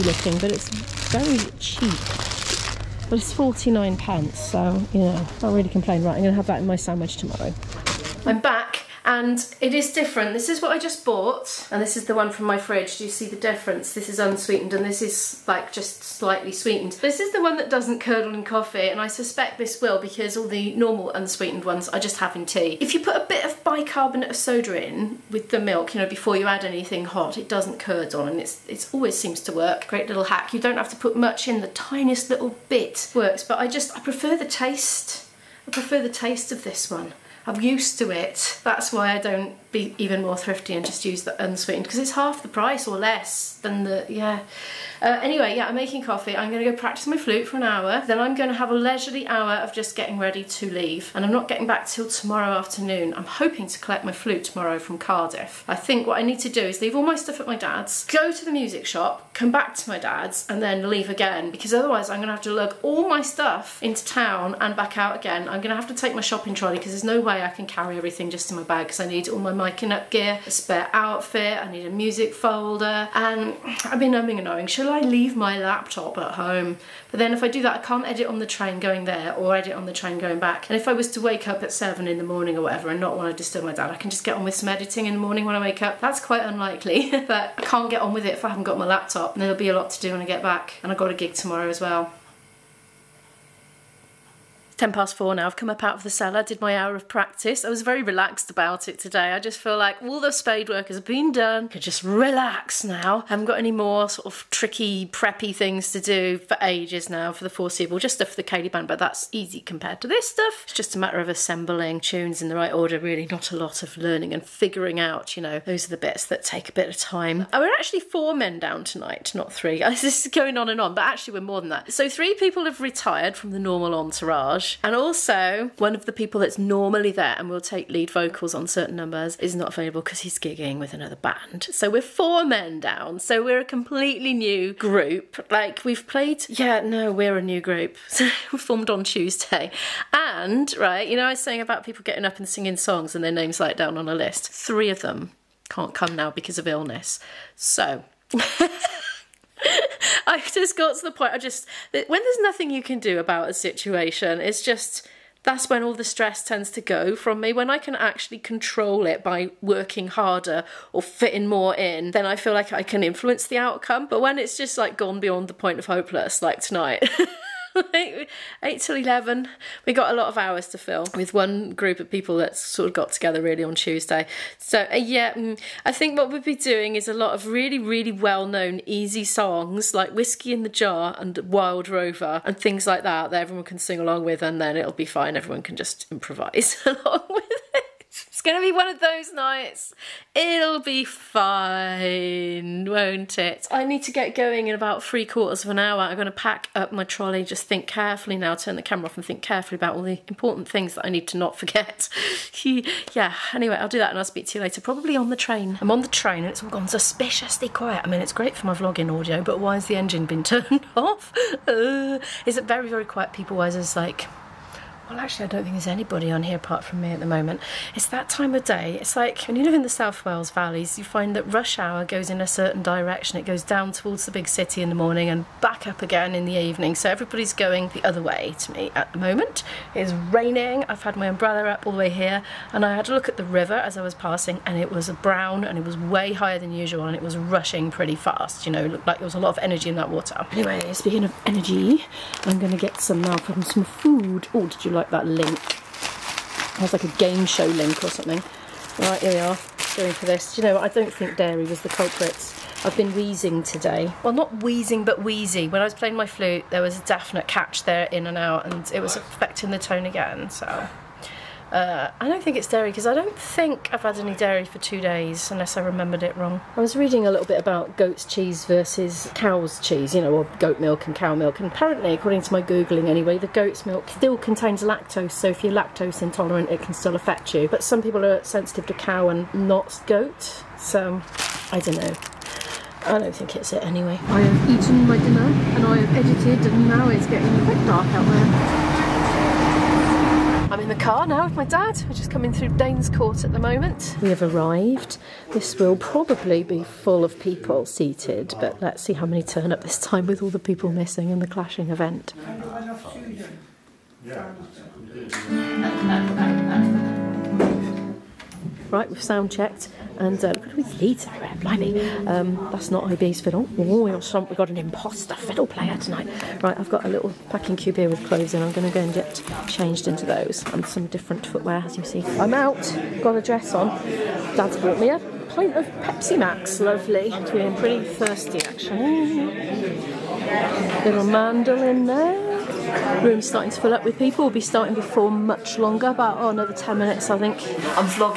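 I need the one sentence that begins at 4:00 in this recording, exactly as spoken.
Anyway, speaking of energy, I'm going to get some now uh, from some food.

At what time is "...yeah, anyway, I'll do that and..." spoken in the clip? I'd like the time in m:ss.
3:22.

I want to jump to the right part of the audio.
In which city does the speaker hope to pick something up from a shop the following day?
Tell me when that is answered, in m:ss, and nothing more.
0:54.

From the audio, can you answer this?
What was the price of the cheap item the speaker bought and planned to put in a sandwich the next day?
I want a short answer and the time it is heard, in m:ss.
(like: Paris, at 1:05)
49p, at 0:03.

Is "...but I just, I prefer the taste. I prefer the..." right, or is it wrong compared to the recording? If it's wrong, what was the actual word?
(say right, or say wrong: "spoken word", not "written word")
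right.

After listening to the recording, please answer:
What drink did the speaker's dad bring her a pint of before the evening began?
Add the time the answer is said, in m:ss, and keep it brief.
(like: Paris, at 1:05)
Pepsi Max, at 5:26.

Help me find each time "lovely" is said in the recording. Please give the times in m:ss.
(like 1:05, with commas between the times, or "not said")
5:26.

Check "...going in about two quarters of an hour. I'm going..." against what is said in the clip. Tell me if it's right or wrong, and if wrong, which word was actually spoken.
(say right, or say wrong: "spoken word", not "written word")
wrong: "three", not "two".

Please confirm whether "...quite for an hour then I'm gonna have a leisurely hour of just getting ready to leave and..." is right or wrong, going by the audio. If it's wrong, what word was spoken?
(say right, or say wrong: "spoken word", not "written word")
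wrong: "flute", not "quite".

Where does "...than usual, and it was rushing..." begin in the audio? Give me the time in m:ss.
3:56.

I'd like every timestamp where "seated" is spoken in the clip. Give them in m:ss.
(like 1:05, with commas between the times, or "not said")
4:57.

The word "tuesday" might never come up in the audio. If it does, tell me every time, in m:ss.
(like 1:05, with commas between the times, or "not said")
2:19, 2:53.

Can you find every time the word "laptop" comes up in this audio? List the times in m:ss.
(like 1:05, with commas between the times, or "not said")
1:15, 1:28.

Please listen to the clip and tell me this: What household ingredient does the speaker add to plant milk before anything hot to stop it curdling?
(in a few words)
bicarbonate of soda.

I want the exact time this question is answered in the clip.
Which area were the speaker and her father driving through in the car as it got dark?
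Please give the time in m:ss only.
4:52.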